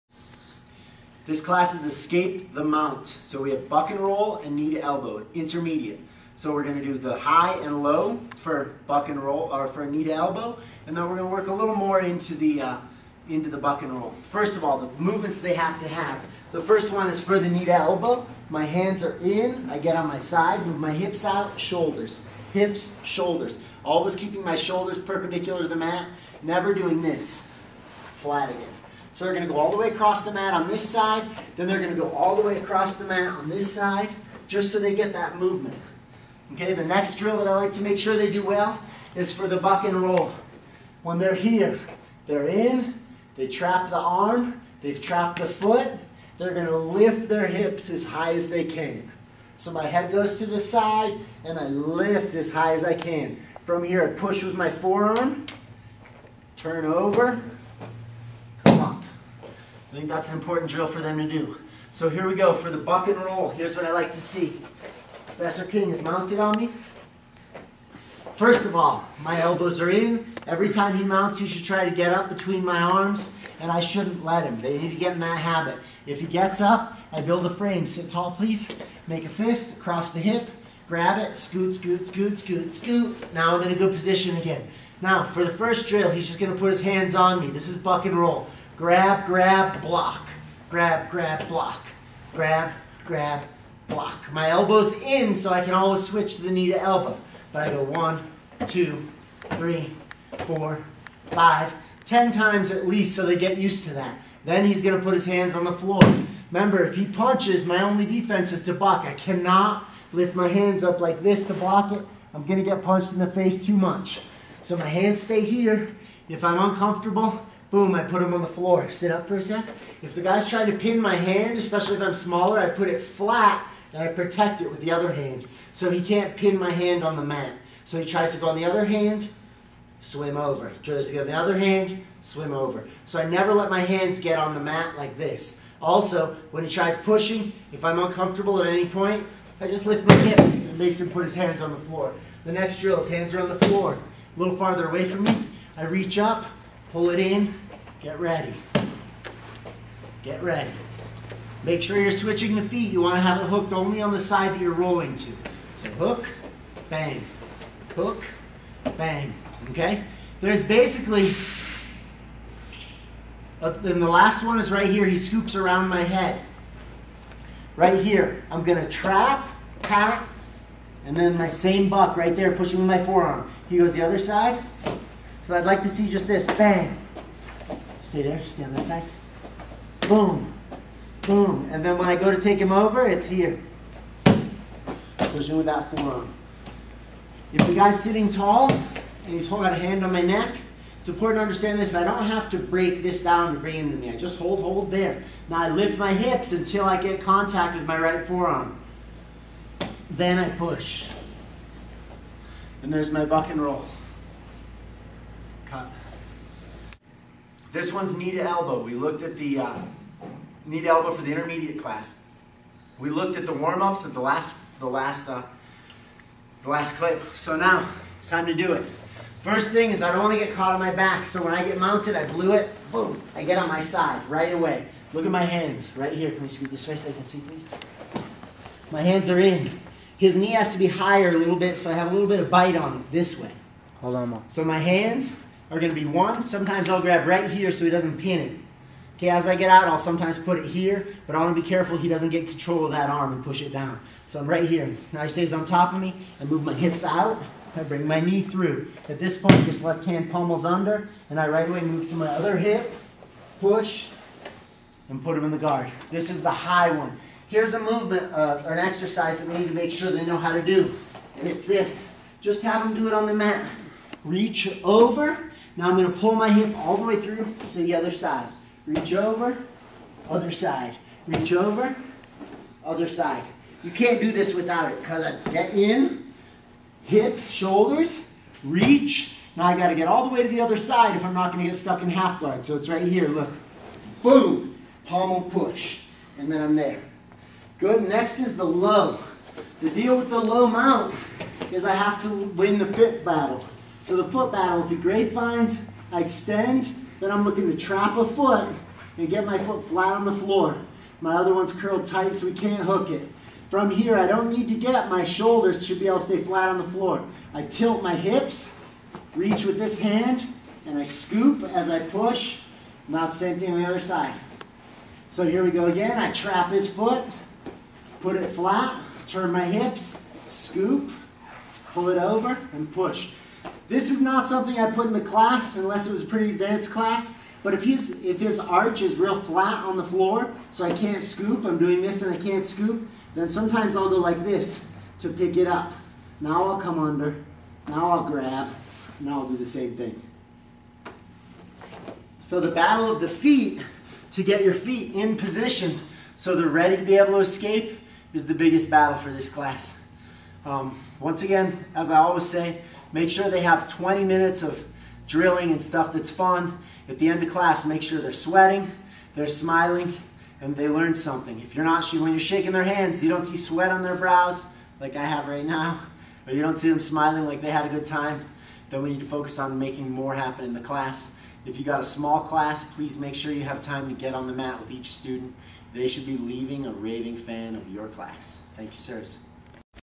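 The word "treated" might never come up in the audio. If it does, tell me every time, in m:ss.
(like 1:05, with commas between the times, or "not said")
not said.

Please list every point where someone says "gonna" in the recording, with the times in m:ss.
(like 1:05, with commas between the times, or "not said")
0:06, 0:11, 2:48.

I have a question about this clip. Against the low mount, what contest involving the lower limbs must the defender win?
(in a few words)
the foot battle.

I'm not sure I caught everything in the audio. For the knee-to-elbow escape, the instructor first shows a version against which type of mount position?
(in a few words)
the high one.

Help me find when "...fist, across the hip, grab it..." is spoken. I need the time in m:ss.
1:19.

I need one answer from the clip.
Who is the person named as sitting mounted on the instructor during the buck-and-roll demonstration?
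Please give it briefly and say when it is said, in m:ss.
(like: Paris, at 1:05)
Professor King, at 1:05.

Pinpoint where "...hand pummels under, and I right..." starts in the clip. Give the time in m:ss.
4:10.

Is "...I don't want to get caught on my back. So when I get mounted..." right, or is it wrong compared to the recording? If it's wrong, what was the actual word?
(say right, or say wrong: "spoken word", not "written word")
right.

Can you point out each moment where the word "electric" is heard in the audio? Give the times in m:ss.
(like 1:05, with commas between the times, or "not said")
not said.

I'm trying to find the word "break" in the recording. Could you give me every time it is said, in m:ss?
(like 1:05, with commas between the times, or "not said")
3:12.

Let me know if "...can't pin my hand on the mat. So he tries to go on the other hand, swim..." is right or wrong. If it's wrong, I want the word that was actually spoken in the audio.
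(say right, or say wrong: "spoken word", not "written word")
right.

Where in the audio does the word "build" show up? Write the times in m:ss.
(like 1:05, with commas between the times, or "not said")
1:17.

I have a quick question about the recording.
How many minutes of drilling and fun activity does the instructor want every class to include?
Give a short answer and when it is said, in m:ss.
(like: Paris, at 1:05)
20, at 5:53.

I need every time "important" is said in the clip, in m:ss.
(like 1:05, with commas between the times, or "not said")
1:00, 3:11.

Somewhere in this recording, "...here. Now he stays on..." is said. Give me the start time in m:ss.
4:04.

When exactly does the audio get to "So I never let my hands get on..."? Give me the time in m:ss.
2:13.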